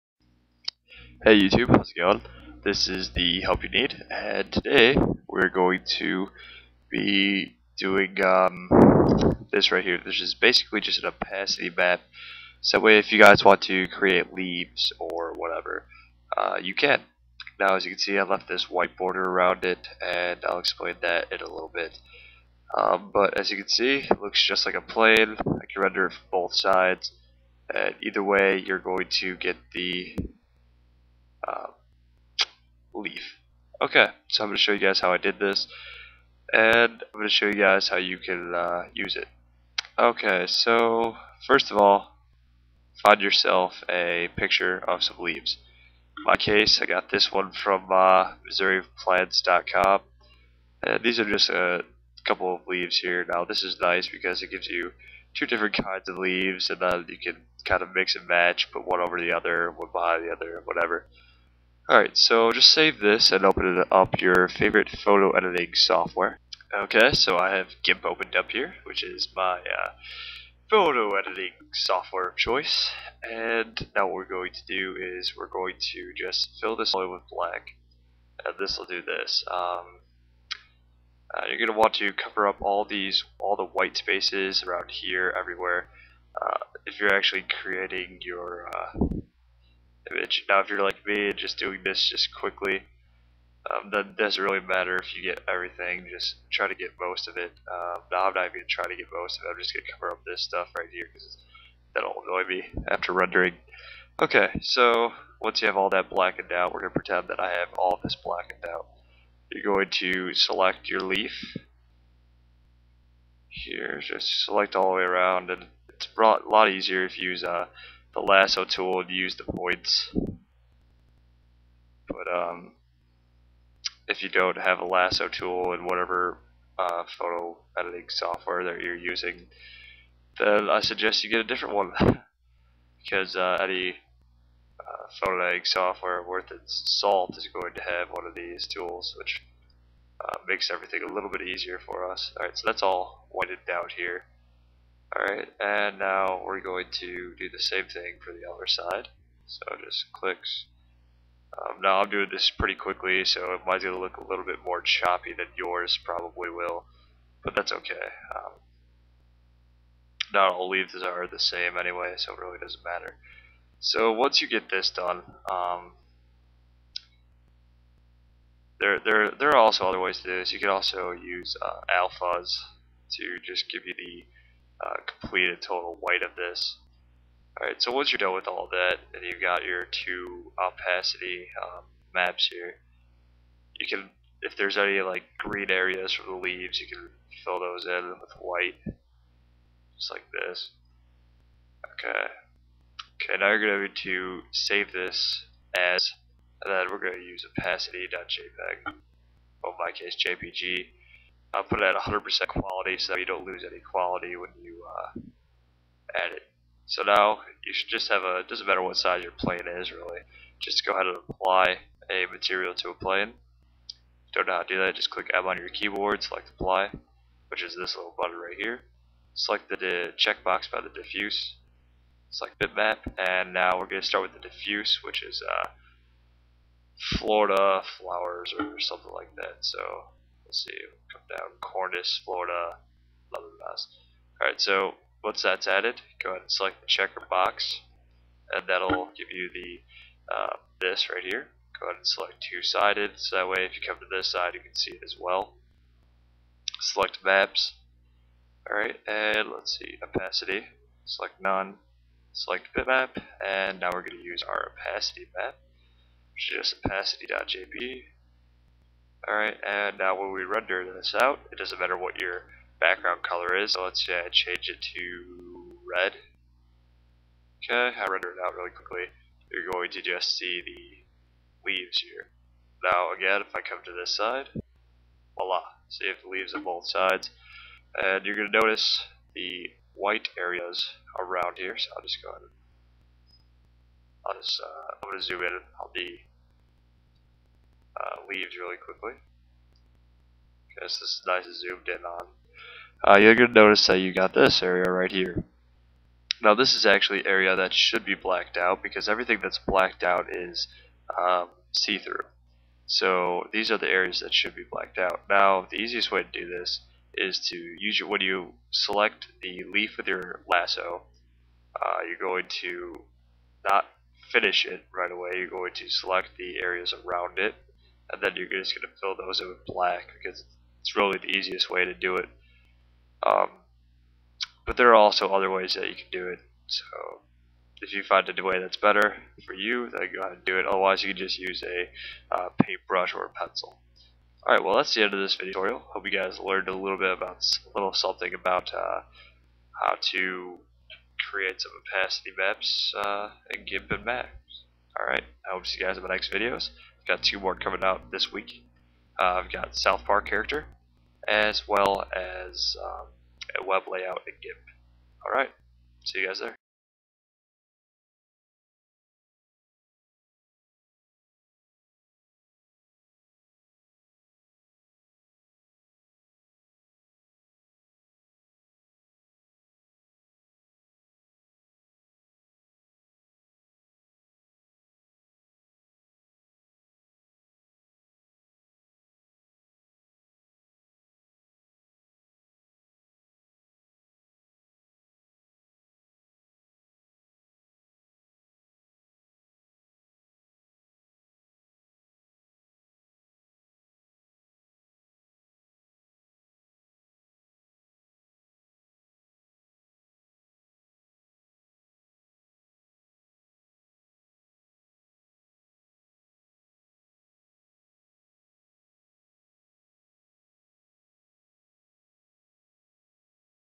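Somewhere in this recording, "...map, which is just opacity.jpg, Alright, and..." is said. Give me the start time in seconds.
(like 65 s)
255 s.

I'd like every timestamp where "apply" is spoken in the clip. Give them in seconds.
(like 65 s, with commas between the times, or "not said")
211 s, 216 s.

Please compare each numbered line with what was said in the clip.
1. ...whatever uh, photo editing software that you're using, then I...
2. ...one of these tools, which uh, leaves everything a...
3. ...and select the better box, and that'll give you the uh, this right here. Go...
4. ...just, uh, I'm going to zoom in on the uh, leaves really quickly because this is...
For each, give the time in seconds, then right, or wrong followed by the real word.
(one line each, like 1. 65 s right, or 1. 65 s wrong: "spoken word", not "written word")
1. 125 s right
2. 138 s wrong: "makes", not "leaves"
3. 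236 s wrong: "checker", not "better"
4. 284 s right.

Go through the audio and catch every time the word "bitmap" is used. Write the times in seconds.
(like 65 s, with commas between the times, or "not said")
222 s, 252 s.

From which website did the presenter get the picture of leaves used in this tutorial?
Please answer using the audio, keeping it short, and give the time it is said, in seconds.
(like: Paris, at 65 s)
MissouriPlants.com, at 48 s.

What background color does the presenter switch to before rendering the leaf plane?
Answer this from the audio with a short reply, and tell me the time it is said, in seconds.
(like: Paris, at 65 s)
red, at 265 s.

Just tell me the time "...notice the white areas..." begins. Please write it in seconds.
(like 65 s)
278 s.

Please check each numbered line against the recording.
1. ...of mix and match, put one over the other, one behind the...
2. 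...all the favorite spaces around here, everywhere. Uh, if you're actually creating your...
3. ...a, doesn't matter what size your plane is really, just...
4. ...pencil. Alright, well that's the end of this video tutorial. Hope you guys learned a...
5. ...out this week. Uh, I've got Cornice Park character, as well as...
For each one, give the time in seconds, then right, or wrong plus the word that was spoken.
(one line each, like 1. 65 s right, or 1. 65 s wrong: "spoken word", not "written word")
1. 57 s right
2. 83 s wrong: "white", not "favorite"
3. 208 s right
4. 333 s right
5. 347 s wrong: "South", not "Cornice".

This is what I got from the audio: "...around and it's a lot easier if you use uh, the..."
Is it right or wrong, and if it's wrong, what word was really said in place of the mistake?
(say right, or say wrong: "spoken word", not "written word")
right.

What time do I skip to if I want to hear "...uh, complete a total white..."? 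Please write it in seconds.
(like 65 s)
174 s.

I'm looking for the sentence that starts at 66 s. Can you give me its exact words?
Okay, so I have GIMP opened up here, which is my uh, photo editing software of choice.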